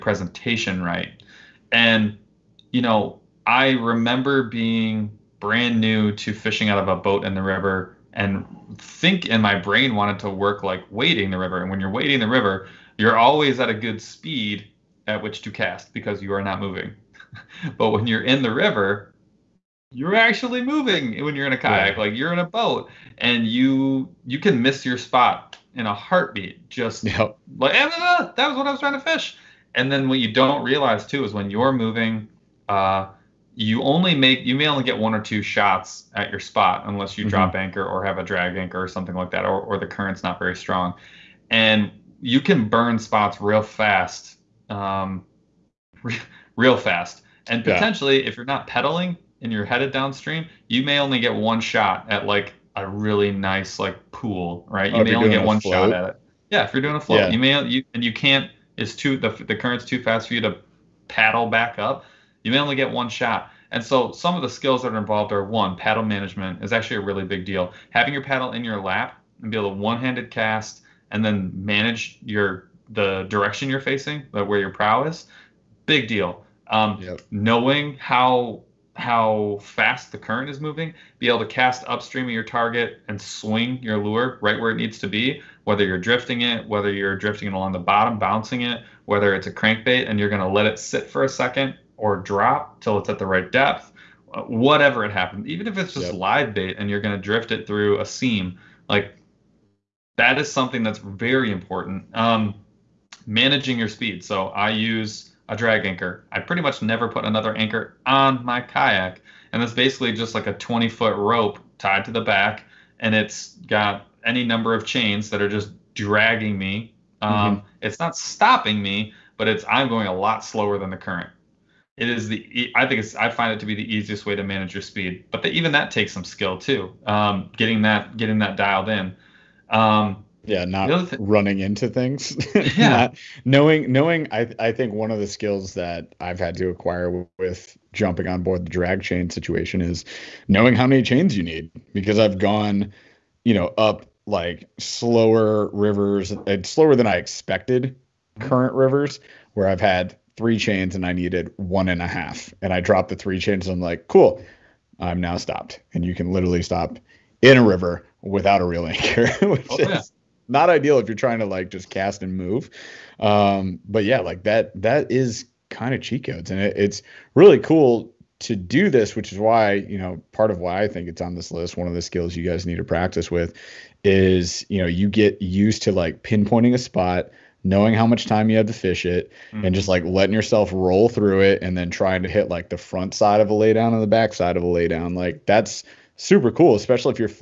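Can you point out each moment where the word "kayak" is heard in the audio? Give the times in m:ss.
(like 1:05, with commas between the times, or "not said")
0:21, 1:48.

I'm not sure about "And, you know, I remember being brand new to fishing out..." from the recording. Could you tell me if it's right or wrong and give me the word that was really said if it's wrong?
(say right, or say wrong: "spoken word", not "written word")
right.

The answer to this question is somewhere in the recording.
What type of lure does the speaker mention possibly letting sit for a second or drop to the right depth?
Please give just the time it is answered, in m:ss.
1:29.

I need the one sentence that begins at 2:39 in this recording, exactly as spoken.
is not ideal if you're trying to like just cast and move.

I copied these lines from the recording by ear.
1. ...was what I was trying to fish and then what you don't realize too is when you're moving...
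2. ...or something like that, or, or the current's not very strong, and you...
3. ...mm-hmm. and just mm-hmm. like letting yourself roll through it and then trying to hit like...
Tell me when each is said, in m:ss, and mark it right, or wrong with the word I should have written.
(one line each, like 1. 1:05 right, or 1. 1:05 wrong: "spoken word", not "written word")
1. 0:28 right
2. 0:38 right
3. 2:59 right.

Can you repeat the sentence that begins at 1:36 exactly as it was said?
live bait and you're going to drift it through a seam, like that is something that's very important.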